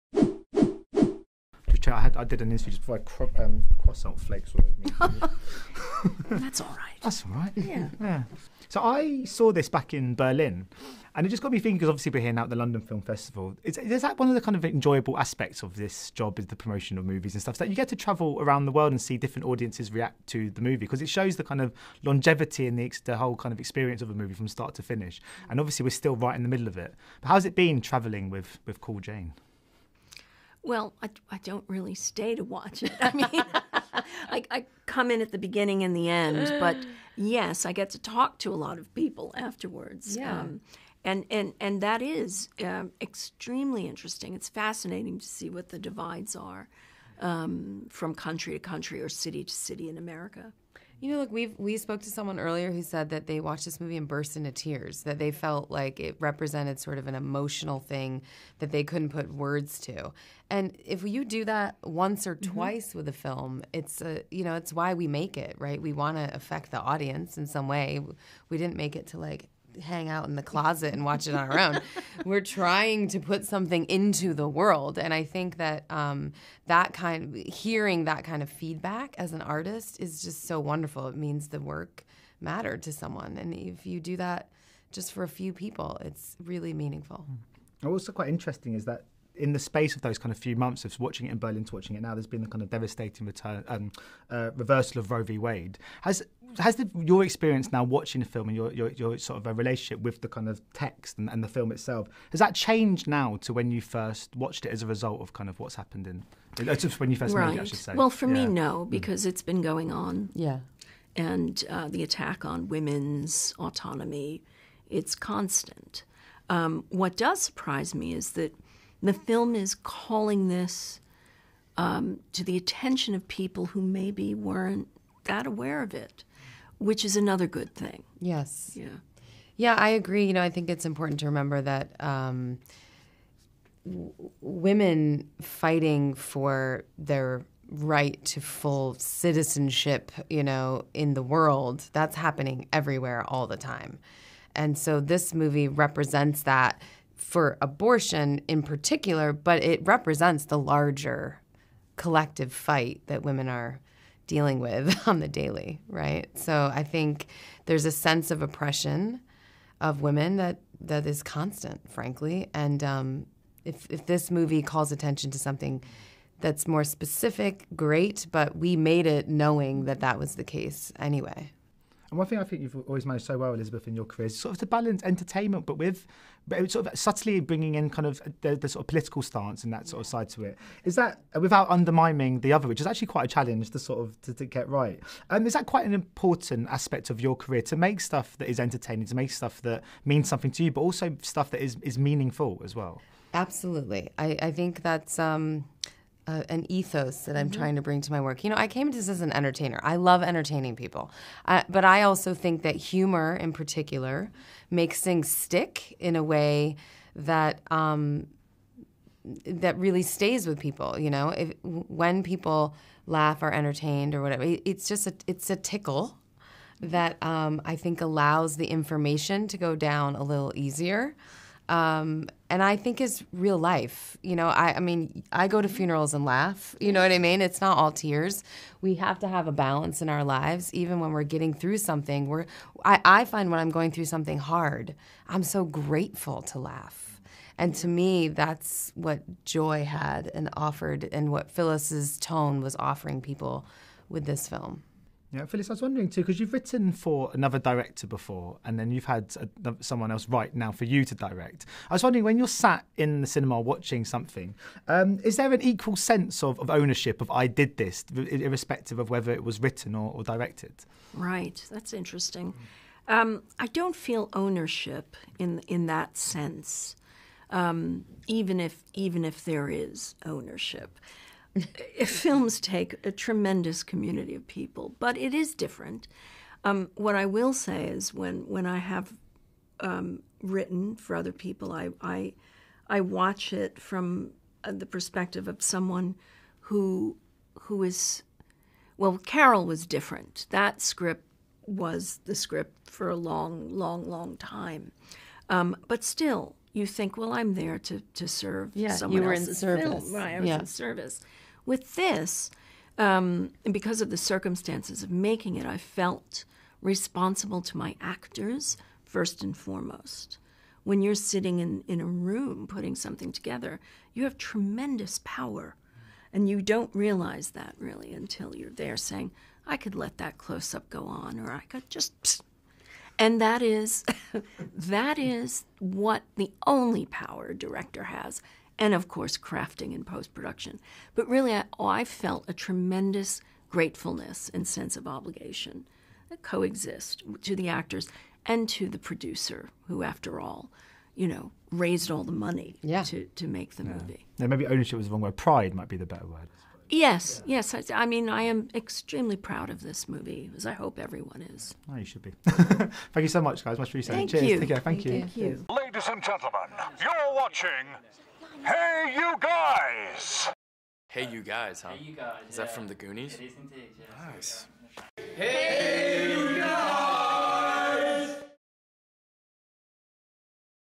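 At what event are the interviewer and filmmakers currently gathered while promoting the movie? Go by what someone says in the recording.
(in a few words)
London Film Festival.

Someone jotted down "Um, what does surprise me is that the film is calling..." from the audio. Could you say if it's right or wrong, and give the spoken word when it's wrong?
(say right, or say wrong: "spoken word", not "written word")
right.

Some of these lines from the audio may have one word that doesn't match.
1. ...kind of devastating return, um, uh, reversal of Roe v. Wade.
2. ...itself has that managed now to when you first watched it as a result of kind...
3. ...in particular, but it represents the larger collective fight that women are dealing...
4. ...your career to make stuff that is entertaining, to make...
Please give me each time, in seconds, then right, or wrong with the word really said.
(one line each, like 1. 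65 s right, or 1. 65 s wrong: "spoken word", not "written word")
1. 92 s right
2. 101 s wrong: "changed", not "managed"
3. 148 s right
4. 187 s right.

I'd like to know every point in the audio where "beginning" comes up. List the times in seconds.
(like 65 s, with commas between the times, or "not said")
35 s.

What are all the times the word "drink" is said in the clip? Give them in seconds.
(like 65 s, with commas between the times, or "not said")
not said.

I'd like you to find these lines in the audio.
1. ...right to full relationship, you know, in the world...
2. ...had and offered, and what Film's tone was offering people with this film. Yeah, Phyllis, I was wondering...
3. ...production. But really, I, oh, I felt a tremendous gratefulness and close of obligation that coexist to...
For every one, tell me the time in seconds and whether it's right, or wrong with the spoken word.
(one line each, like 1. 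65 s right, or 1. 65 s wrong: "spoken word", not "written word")
1. 137 s wrong: "citizenship", not "relationship"
2. 239 s wrong: "Phyllis", not "Film"
3. 330 s wrong: "sense", not "close".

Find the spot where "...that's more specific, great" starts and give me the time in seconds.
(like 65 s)
166 s.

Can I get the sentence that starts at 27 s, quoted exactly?
But how's it been travelling with with Call Jane?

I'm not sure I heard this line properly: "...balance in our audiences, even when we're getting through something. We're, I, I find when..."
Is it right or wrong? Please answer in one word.
wrong.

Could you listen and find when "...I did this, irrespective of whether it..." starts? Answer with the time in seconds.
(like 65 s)
257 s.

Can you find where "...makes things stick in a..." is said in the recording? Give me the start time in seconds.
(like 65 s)
204 s.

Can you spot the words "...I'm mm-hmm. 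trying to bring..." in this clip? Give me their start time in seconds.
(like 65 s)
197 s.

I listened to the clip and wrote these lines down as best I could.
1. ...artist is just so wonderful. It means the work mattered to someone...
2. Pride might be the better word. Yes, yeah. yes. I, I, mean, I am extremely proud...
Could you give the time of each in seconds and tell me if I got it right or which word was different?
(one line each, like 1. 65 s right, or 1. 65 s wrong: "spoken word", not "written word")
1. 79 s right
2. 345 s right.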